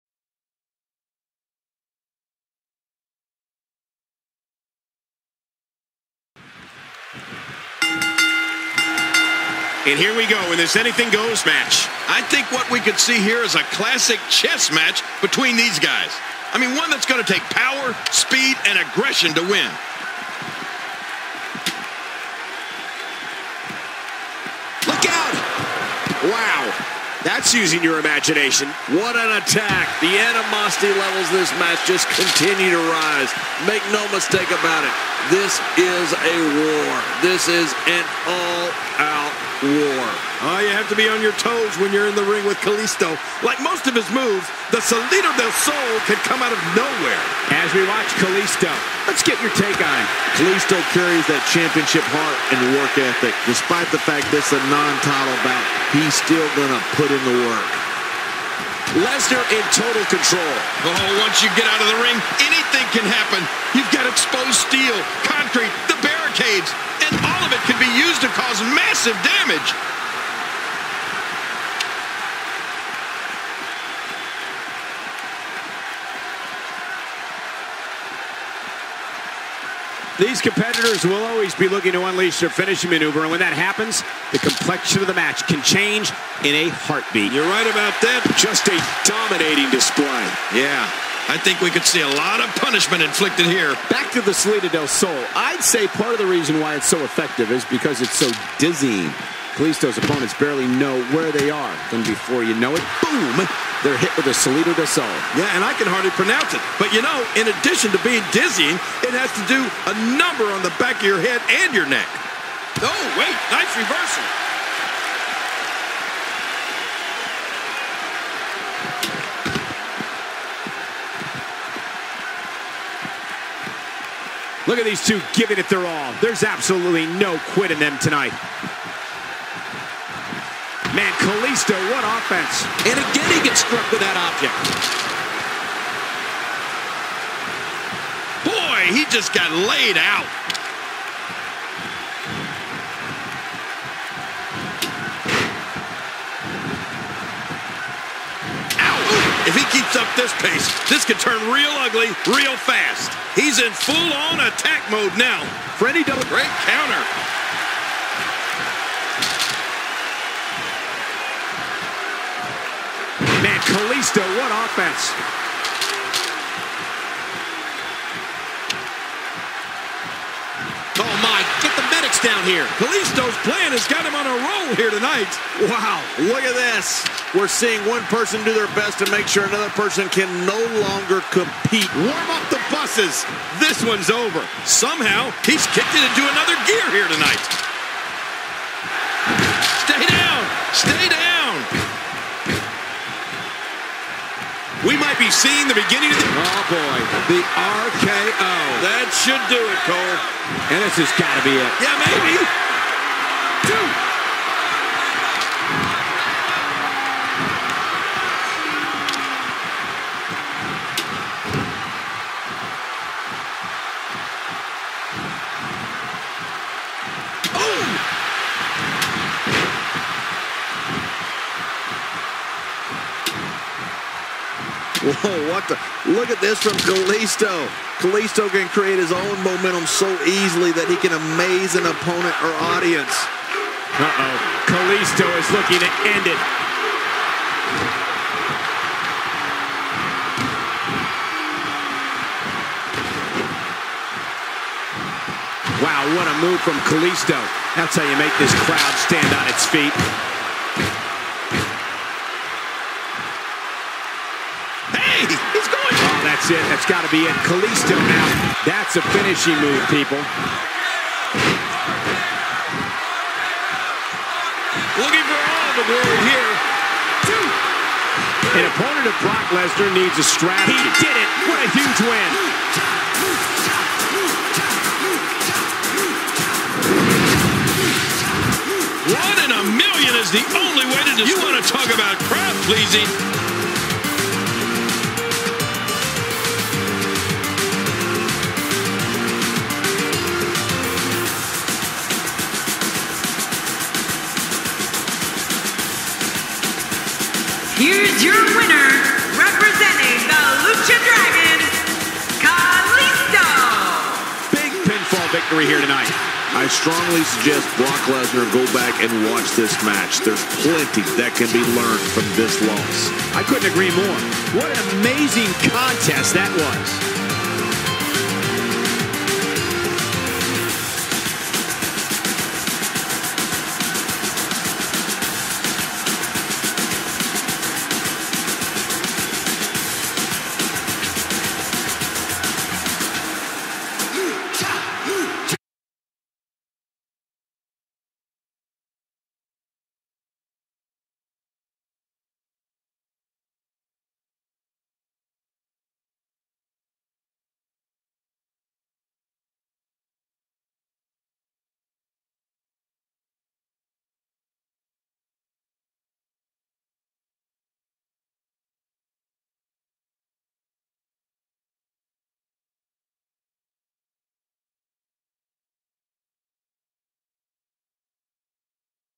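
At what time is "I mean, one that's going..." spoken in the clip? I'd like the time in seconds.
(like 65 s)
16 s.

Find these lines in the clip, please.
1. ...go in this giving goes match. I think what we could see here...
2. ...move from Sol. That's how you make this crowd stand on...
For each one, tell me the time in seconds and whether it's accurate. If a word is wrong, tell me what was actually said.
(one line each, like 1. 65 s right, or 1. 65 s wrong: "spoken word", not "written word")
1. 10 s wrong: "anything", not "giving"
2. 246 s wrong: "Kalisto", not "Sol".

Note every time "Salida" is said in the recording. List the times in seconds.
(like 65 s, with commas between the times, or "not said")
44 s, 94 s, 104 s.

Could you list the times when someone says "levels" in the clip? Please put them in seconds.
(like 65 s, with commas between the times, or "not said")
30 s.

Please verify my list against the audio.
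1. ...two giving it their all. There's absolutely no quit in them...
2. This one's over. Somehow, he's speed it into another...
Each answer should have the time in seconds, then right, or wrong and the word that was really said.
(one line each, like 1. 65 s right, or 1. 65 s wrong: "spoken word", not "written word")
1. 125 s right
2. 183 s wrong: "kicked", not "speed".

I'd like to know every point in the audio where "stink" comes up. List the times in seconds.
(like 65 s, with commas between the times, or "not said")
not said.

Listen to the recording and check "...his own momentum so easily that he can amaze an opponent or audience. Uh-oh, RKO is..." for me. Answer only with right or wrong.
wrong.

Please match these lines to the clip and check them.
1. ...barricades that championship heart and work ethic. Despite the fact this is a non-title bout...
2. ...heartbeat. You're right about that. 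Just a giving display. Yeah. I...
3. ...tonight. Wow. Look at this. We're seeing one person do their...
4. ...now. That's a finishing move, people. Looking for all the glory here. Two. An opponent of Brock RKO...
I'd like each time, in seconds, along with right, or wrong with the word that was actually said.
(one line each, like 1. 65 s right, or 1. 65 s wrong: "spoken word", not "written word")
1. 50 s wrong: "carries", not "barricades"
2. 86 s wrong: "dominating", not "giving"
3. 174 s right
4. 257 s wrong: "Lesnar", not "RKO".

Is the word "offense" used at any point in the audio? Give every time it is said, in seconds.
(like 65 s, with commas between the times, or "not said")
132 s, 164 s.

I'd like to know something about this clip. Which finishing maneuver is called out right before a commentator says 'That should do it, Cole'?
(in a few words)
The RKO.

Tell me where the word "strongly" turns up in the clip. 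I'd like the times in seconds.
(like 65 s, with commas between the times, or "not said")
306 s.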